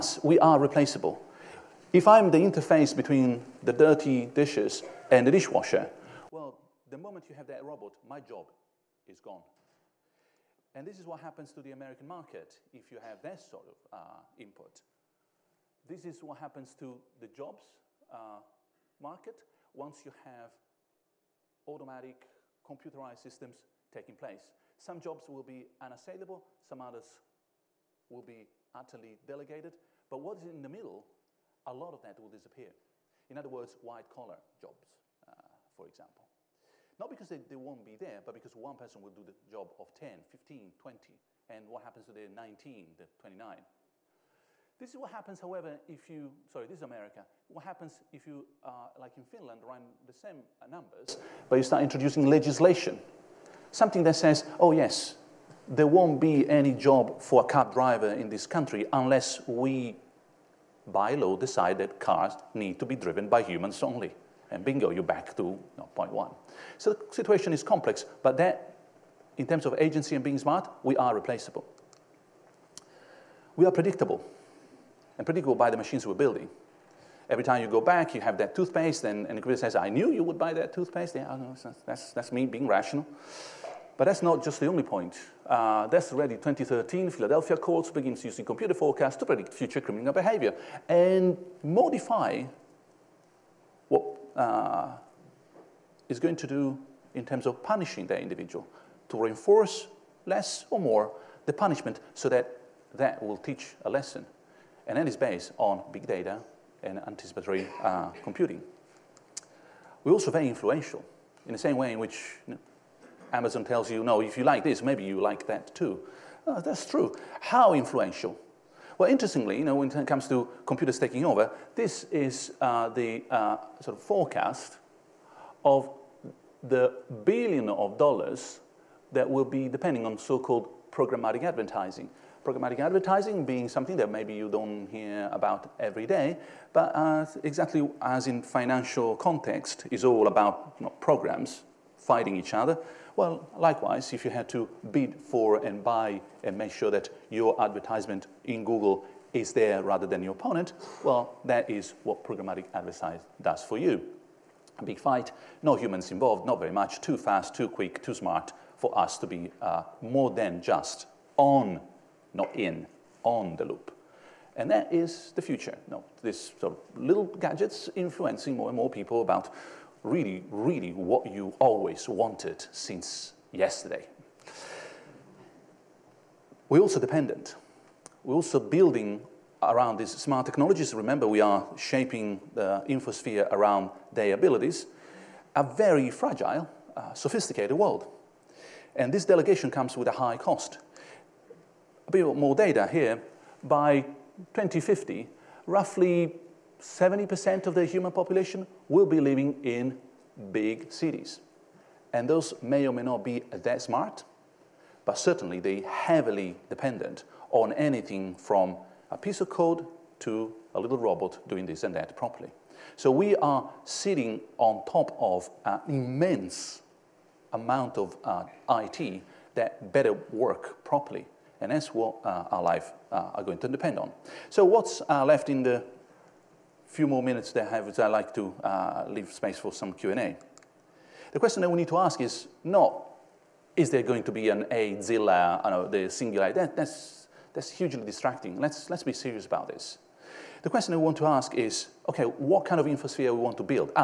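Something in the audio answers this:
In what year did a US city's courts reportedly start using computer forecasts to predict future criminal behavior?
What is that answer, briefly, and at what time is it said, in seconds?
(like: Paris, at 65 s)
2013, at 86 s.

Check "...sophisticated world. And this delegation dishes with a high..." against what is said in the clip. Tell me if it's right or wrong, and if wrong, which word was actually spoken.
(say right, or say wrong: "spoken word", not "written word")
wrong: "comes", not "dishes".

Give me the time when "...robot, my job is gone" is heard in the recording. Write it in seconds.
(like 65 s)
7 s.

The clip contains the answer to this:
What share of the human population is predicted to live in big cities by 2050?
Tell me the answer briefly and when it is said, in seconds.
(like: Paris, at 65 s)
70%, at 196 s.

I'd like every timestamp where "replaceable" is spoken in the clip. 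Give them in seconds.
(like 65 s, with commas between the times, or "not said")
0 s, 71 s.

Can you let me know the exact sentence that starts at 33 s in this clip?
In other words, white collar jobs.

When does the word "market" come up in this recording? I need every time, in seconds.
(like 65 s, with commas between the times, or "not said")
12 s, 18 s.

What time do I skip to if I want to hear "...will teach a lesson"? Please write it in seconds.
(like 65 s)
103 s.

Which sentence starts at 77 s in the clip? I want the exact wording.
Every time you go back, you have that toothpaste, and, and the computer says, I knew you would buy that toothpaste.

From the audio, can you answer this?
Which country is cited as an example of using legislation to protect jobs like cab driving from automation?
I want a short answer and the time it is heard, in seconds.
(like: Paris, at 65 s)
Finland, at 49 s.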